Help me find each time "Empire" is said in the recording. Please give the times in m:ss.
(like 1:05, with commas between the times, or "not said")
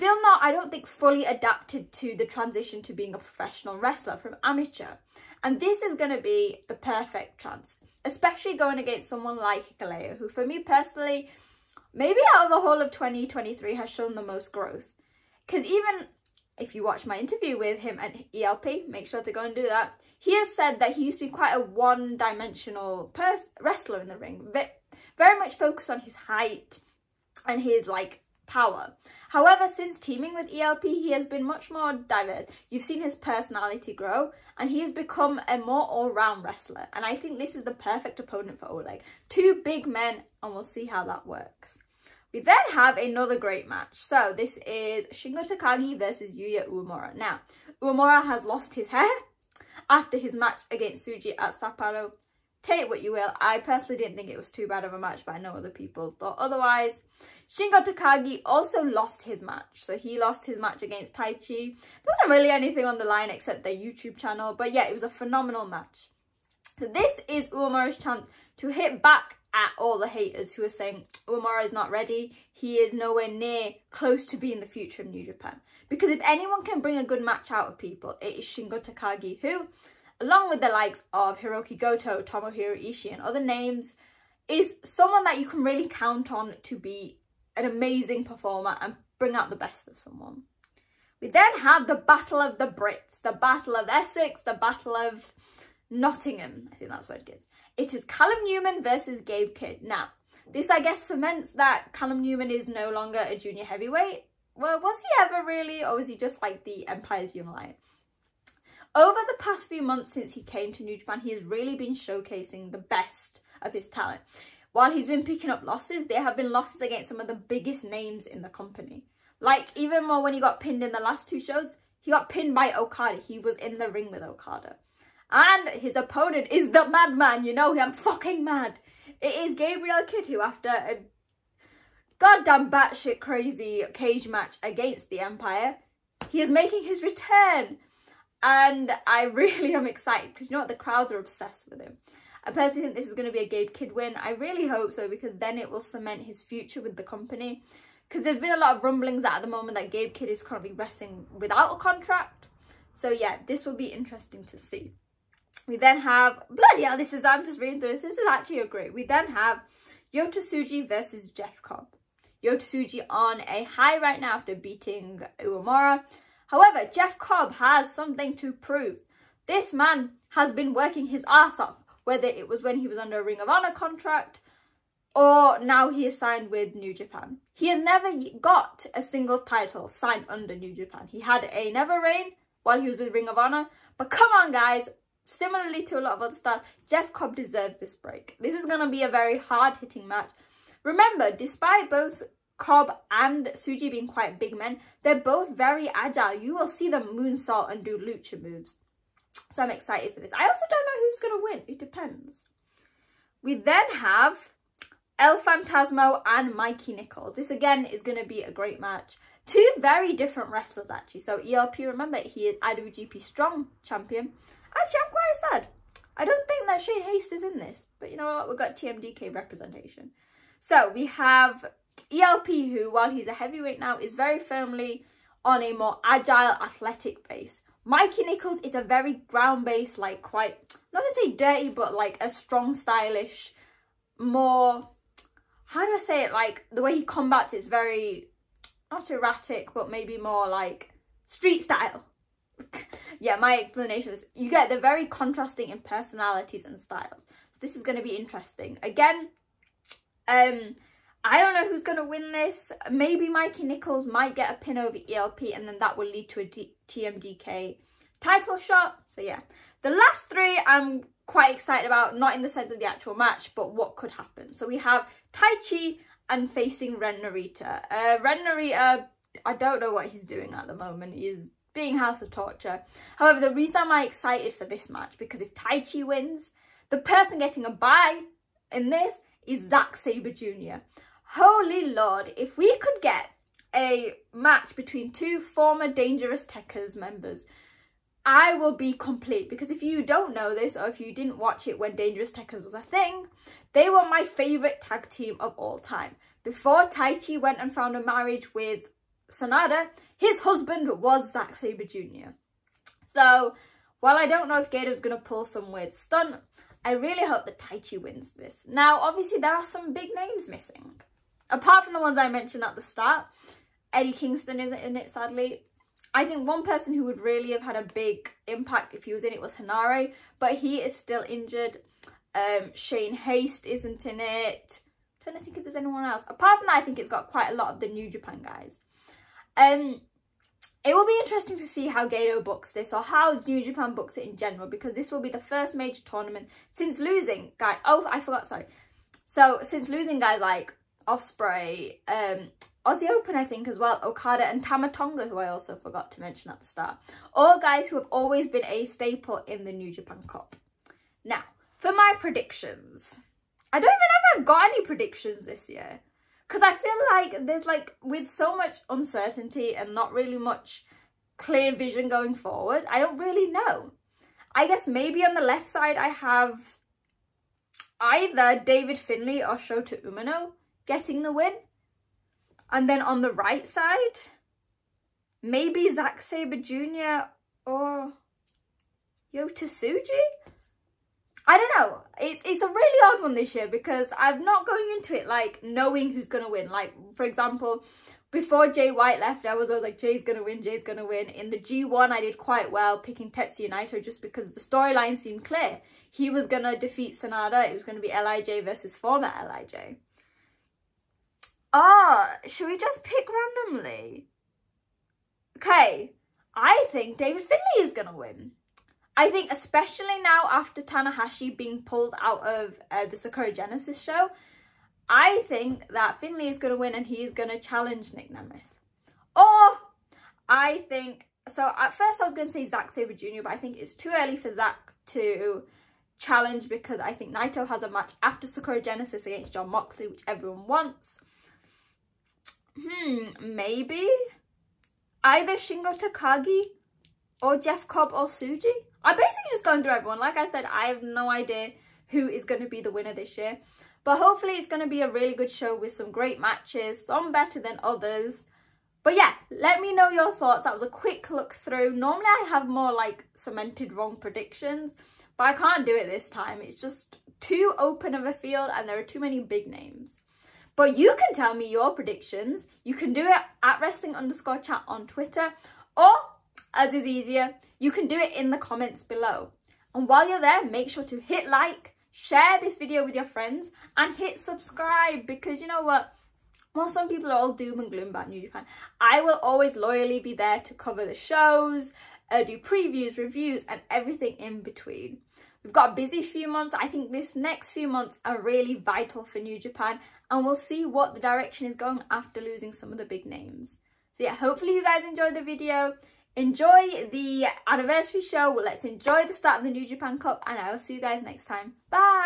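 1:46, 2:15.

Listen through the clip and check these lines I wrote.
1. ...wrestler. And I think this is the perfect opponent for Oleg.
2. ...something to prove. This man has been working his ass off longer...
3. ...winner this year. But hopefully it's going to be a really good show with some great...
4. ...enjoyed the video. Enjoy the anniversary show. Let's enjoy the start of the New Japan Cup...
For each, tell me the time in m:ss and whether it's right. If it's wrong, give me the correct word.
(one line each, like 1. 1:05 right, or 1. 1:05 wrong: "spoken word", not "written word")
1. 0:36 right
2. 2:47 wrong: "whether", not "longer"
3. 7:22 right
4. 8:15 right.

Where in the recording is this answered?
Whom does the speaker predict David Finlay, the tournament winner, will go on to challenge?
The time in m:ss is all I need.
6:58.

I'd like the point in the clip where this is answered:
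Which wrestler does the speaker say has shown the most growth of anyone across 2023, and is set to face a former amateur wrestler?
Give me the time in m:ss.
0:09.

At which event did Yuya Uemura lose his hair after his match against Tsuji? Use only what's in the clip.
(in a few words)
Sapporo.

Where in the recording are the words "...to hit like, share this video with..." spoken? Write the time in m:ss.
7:51.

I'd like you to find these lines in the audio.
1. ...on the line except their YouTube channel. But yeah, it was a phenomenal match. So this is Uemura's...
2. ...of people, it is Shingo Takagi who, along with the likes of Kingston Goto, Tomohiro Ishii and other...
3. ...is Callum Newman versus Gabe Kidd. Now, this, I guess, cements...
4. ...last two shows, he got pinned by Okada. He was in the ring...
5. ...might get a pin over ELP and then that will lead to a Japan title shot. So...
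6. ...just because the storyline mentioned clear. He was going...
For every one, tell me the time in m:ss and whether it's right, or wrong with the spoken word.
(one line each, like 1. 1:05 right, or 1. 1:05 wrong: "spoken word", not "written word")
1. 1:02 right
2. 1:17 wrong: "Hiroki", not "Kingston"
3. 1:37 right
4. 2:00 right
5. 4:14 wrong: "TMDK", not "Japan"
6. 6:34 wrong: "seemed", not "mentioned".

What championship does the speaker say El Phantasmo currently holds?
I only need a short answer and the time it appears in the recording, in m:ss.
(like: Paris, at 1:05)
IWGP Strong Champion, at 3:32.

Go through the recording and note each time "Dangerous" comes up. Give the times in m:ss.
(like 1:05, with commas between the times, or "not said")
4:45, 4:51.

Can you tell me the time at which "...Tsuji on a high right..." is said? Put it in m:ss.
2:42.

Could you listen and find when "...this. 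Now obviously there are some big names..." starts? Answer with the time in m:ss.
5:08.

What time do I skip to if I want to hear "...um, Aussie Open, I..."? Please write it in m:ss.
5:42.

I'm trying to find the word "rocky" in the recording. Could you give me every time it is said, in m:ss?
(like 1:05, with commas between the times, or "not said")
not said.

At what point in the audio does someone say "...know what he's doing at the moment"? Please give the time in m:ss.
4:29.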